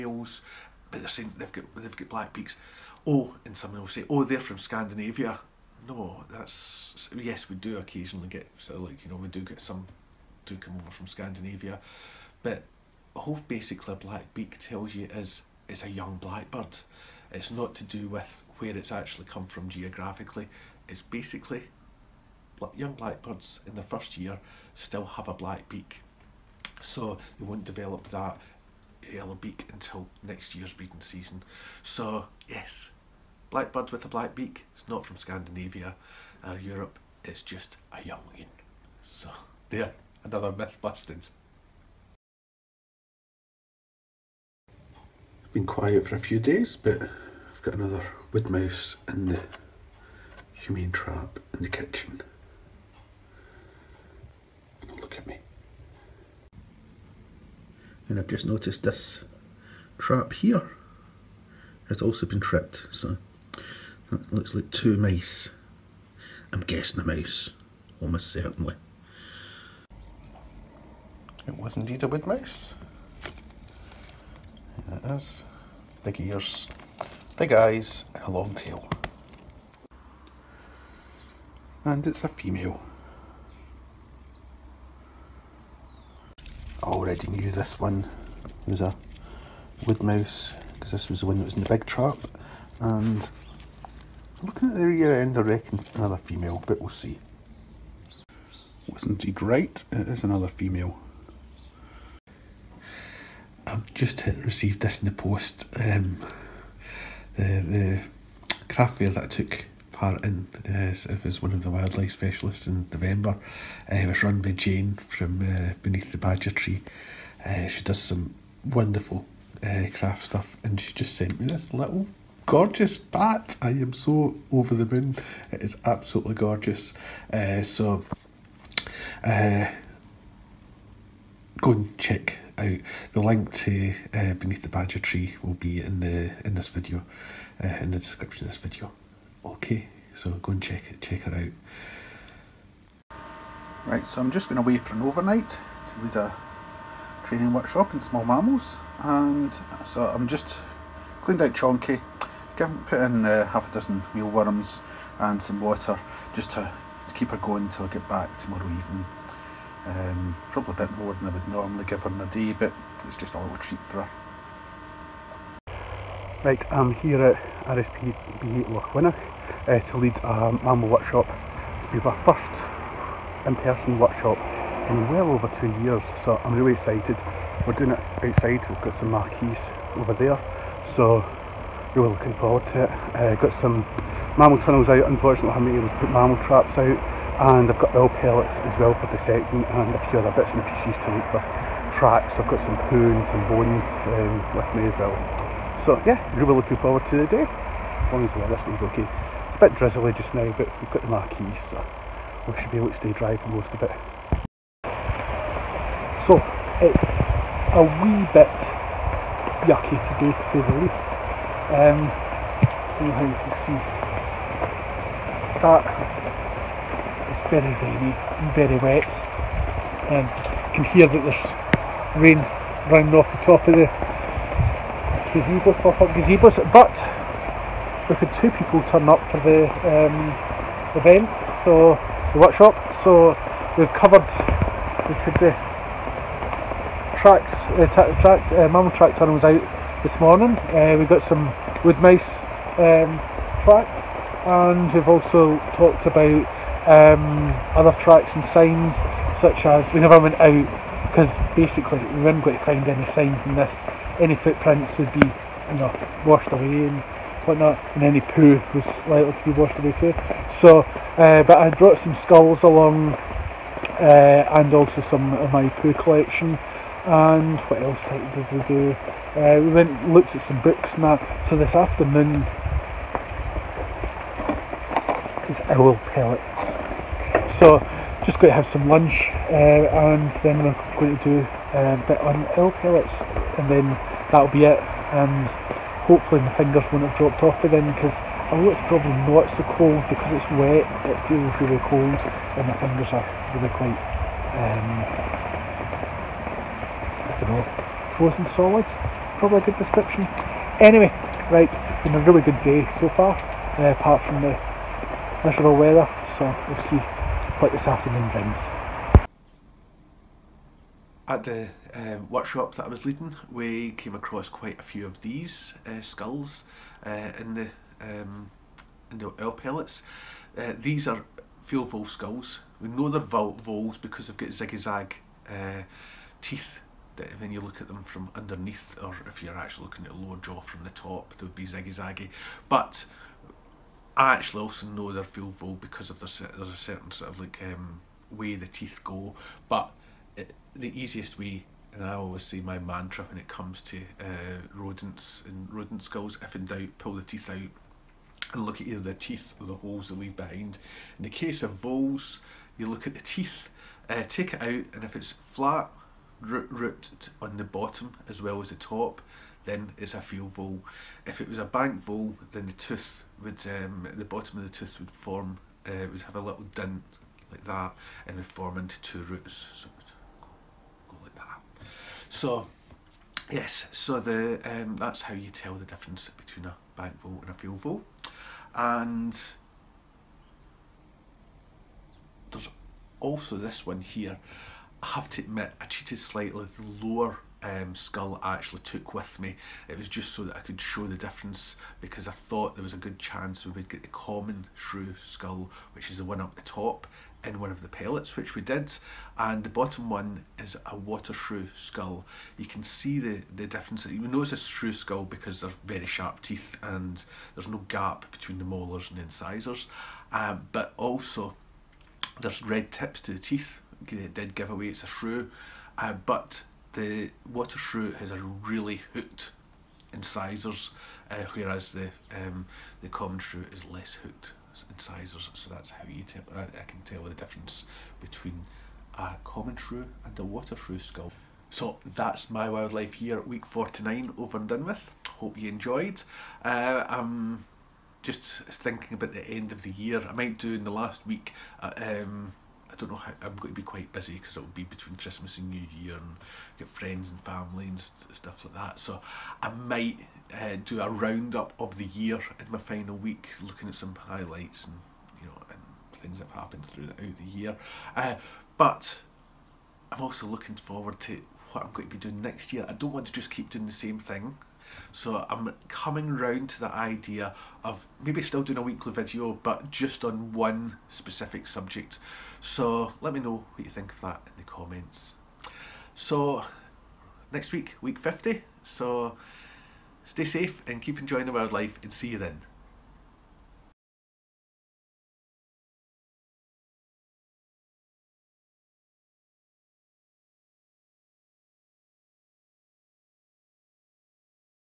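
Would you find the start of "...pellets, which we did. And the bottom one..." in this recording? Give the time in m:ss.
6:37.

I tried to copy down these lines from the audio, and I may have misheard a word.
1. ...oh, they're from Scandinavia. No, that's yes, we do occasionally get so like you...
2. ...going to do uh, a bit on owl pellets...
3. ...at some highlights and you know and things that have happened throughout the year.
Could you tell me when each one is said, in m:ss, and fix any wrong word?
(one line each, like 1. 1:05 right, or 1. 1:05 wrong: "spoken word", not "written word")
1. 0:04 right
2. 4:40 right
3. 7:33 right.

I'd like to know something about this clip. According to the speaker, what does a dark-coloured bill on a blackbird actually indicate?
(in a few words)
A young blackbird.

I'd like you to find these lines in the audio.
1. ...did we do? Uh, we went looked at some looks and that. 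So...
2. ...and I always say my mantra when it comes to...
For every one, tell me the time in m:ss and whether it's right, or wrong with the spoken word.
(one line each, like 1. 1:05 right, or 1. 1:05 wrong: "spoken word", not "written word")
1. 4:28 wrong: "books", not "looks"
2. 5:41 right.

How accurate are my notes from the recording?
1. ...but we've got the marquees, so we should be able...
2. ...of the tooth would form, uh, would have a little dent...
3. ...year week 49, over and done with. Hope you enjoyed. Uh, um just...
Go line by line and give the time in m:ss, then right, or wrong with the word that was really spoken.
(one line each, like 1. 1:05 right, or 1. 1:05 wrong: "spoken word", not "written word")
1. 3:20 right
2. 6:04 right
3. 7:13 right.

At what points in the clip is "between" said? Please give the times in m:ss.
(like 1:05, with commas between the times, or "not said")
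6:16, 6:48, 7:08, 7:24.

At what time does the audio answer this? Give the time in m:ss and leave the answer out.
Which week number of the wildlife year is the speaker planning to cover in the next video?
7:57.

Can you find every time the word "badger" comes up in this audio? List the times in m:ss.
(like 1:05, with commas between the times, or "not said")
1:56, 2:14.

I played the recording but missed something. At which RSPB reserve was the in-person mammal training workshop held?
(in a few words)
RSPB Lochwinnoch.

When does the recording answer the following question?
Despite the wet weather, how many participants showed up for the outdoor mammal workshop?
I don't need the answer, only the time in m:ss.
3:48.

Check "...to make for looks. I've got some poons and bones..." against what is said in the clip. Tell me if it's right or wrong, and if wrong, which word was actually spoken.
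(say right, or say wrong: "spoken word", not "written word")
wrong: "tracks", not "looks".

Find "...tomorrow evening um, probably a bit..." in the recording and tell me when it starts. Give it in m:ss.
2:38.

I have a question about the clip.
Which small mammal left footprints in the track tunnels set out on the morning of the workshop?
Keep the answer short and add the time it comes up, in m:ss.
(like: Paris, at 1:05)
Wood mice, at 4:01.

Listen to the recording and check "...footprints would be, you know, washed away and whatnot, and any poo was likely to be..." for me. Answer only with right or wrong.
right.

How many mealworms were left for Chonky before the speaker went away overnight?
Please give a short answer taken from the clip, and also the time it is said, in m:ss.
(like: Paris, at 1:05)
Half a dozen, at 2:33.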